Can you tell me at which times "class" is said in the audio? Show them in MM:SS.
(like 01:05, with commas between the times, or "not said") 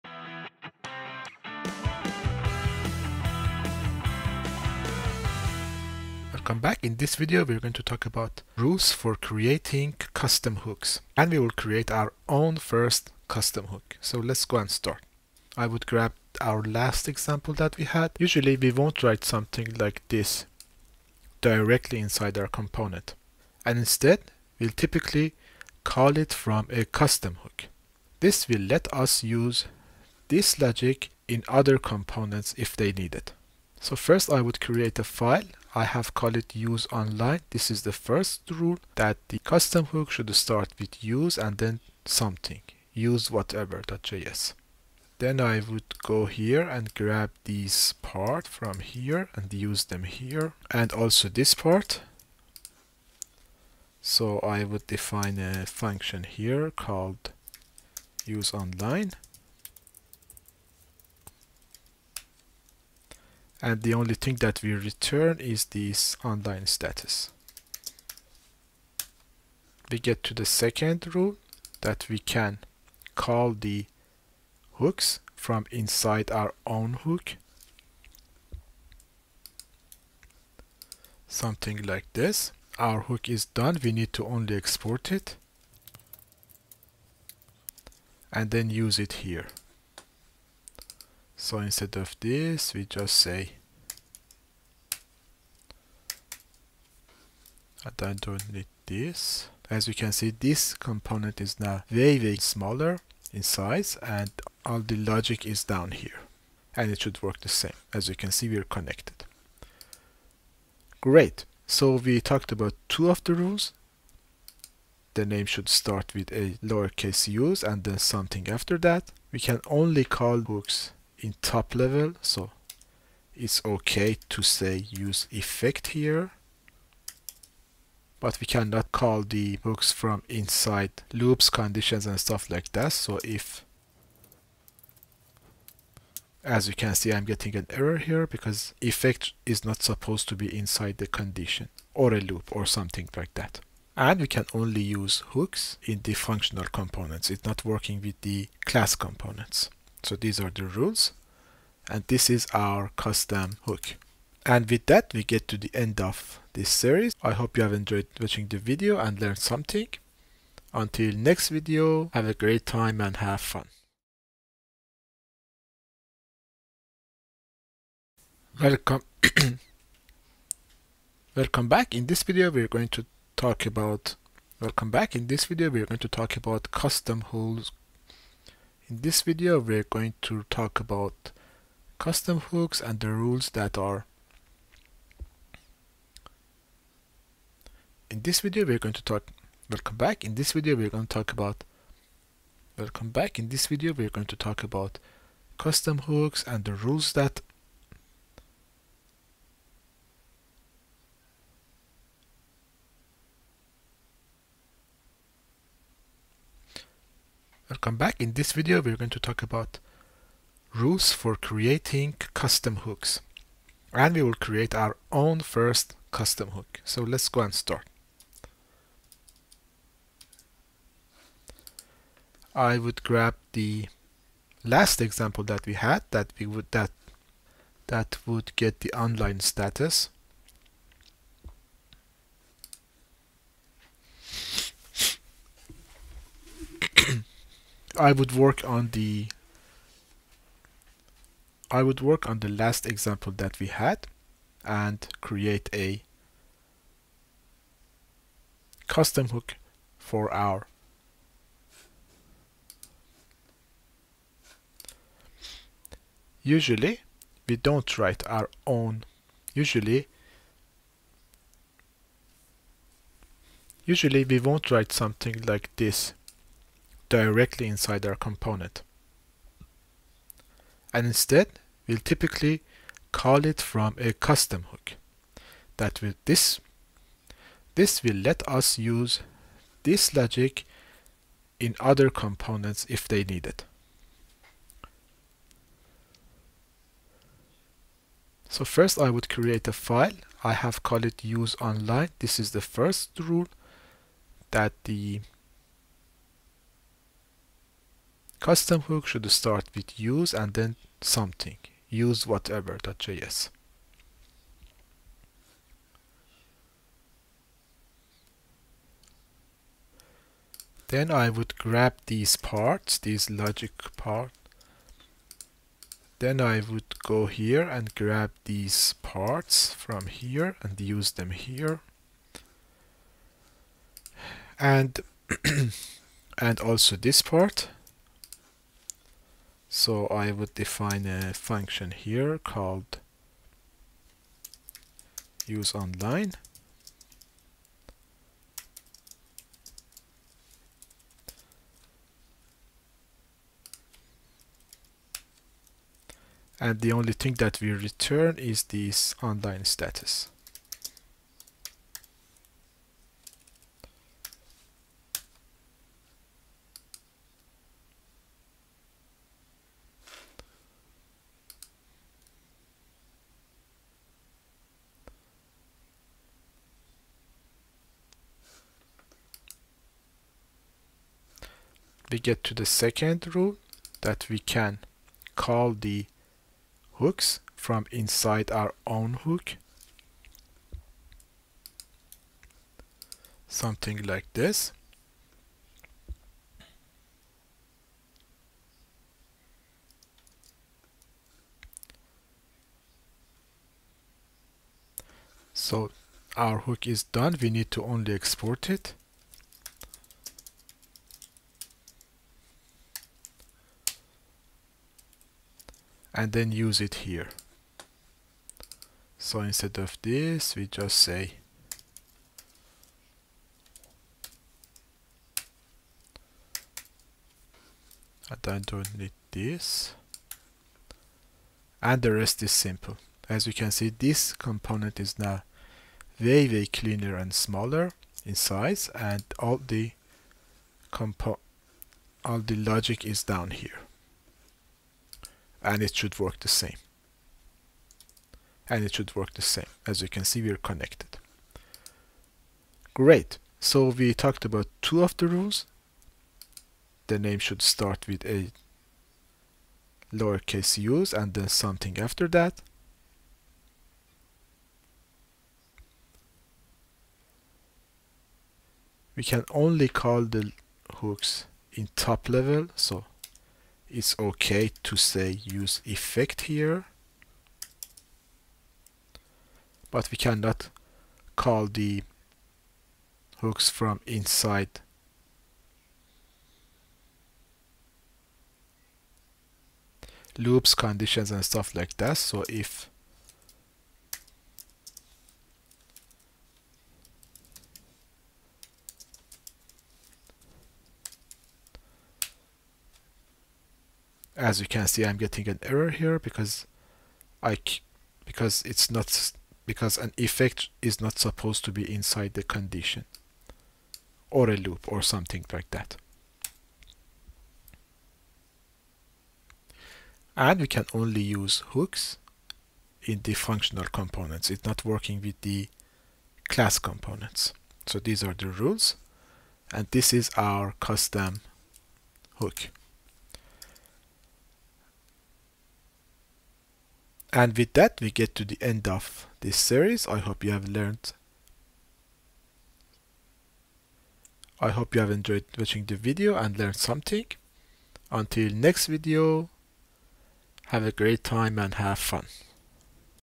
02:28, 08:36.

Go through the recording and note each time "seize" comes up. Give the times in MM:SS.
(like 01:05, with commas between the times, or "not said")
not said.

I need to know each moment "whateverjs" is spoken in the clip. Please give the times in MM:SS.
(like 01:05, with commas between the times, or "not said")
00:43, 05:02.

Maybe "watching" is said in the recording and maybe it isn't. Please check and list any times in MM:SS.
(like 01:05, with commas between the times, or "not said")
02:38, 08:55.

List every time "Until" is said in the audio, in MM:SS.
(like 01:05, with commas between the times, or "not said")
02:40, 08:58.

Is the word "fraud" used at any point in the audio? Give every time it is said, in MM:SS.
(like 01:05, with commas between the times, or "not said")
not said.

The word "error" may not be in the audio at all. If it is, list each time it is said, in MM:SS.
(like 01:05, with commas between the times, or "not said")
02:17, 08:15.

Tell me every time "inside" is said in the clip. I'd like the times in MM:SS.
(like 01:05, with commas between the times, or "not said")
00:21, 01:15, 02:10, 02:20, 04:27, 06:17, 07:54, 08:21.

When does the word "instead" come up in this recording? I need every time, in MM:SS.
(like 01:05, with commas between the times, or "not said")
00:23, 01:31, 04:31, 06:49.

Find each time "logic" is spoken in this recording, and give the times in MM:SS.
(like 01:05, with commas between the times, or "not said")
00:30, 01:44, 04:40, 05:13, 07:12.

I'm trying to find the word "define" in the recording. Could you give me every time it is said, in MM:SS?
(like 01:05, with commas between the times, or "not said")
00:54, 05:30.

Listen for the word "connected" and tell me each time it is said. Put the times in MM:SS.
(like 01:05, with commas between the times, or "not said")
01:48, 07:20.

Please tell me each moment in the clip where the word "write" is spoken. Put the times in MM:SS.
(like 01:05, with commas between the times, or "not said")
00:19, 04:17, 04:24.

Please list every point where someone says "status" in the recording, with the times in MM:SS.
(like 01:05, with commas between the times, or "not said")
01:06, 03:49, 05:49.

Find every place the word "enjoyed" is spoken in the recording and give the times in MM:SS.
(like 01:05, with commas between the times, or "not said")
02:37, 08:55.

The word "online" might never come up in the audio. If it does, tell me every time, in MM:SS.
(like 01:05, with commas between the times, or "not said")
00:36, 00:58, 01:06, 03:48, 04:51, 05:35, 05:49.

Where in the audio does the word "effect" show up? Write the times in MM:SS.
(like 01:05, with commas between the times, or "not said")
02:05, 02:18, 07:45, 08:20.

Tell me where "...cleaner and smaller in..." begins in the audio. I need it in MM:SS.
07:06.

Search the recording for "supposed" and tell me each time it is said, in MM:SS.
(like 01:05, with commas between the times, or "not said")
02:19, 08:21.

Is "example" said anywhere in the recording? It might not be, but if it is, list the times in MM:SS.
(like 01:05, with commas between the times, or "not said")
00:17, 03:45, 04:02.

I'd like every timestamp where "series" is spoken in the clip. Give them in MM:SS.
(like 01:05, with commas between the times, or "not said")
02:36, 08:49.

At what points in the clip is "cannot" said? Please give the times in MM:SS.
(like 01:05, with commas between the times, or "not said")
02:08, 07:50.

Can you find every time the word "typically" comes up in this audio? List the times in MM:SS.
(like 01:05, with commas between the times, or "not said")
00:24, 04:31.